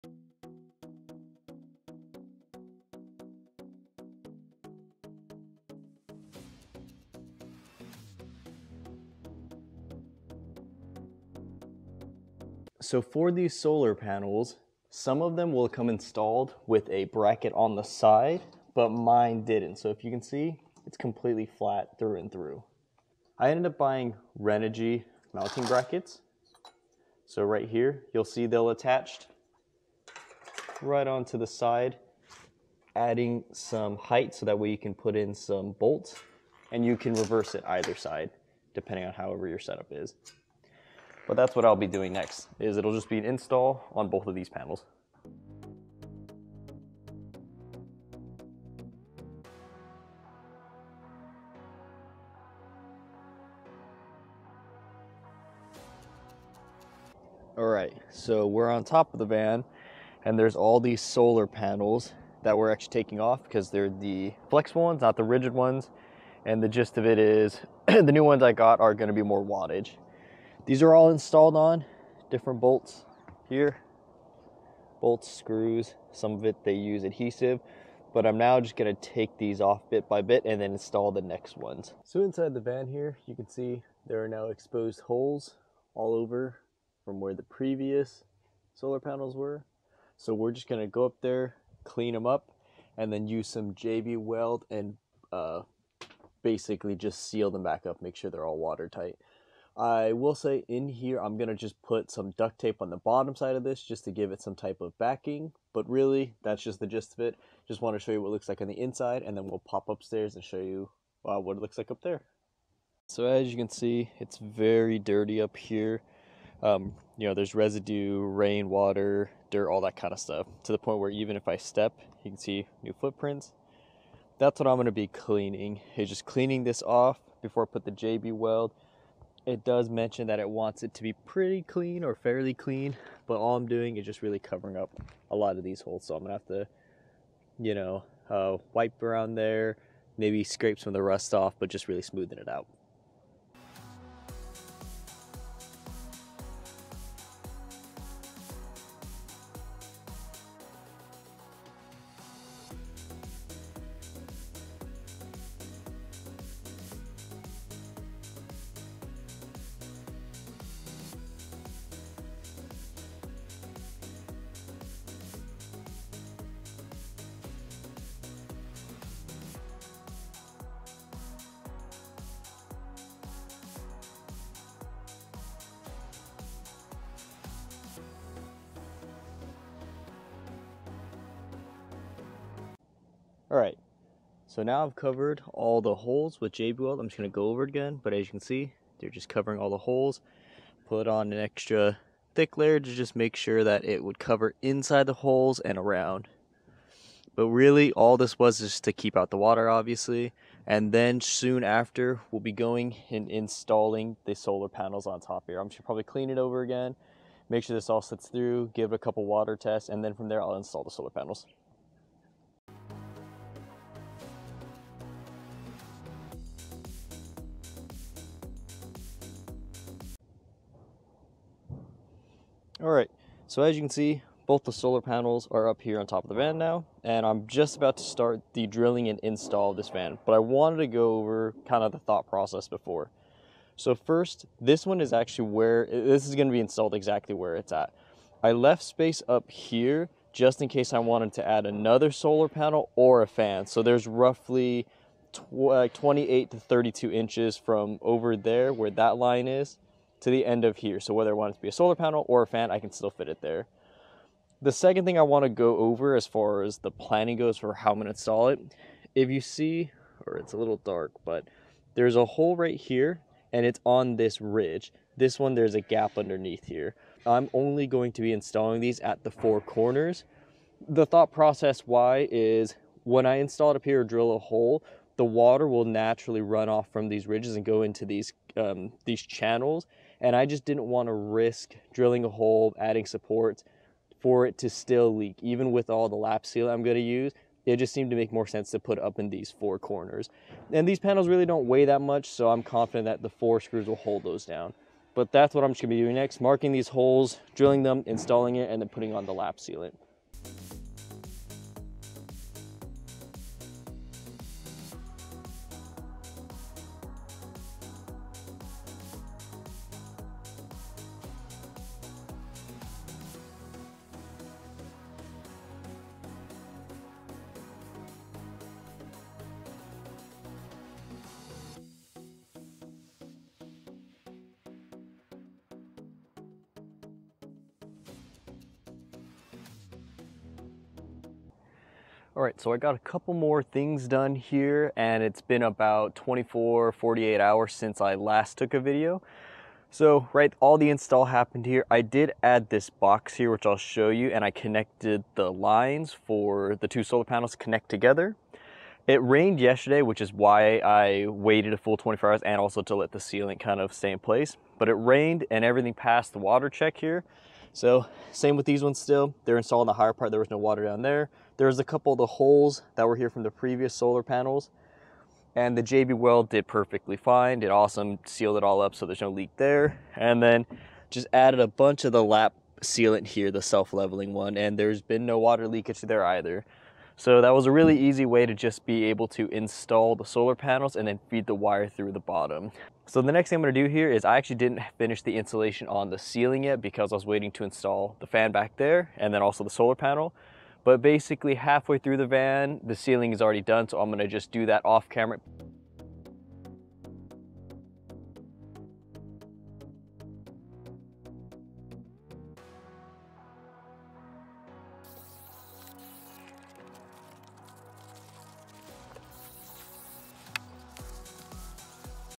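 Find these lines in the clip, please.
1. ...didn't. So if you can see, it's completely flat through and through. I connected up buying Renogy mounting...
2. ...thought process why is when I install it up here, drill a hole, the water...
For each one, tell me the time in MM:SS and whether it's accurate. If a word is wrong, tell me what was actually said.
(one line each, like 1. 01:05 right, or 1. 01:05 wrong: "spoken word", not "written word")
1. 00:19 wrong: "ended", not "connected"
2. 04:31 right.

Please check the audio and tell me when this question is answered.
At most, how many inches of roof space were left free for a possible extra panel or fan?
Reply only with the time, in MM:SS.
04:06.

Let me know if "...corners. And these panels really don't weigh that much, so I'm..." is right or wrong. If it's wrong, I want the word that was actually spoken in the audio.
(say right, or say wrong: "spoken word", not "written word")
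right.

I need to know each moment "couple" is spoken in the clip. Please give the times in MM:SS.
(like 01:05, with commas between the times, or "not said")
03:28, 05:32, 06:01.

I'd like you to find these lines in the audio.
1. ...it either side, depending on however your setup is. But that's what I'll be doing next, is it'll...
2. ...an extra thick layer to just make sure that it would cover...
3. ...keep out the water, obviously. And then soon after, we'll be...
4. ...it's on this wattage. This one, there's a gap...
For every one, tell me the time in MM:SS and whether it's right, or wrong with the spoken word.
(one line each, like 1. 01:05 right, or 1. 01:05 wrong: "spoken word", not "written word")
1. 00:37 right
2. 03:11 right
3. 03:18 right
4. 04:23 wrong: "ridge", not "wattage".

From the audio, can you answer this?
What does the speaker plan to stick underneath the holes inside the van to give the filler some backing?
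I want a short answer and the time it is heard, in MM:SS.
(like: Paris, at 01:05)
duct tape, at 01:42.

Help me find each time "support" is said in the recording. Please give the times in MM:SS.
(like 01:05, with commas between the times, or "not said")
04:43.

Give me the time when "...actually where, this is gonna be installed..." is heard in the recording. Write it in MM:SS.
03:55.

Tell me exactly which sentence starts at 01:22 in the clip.
So inside the van here, you can see there are now exposed holes all over from where the previous solar panels were.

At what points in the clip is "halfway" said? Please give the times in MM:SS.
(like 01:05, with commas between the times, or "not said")
06:31.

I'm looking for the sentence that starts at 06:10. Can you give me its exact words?
And then just added a bunch of the lap sealant here, the self-leveling one, and there's been no water leakage there either.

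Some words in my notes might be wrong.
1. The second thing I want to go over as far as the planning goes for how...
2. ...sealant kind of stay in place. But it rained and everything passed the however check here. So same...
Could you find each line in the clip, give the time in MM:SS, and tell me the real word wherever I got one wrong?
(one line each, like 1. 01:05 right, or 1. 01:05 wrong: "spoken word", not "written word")
1. 04:14 right
2. 05:53 wrong: "water", not "however".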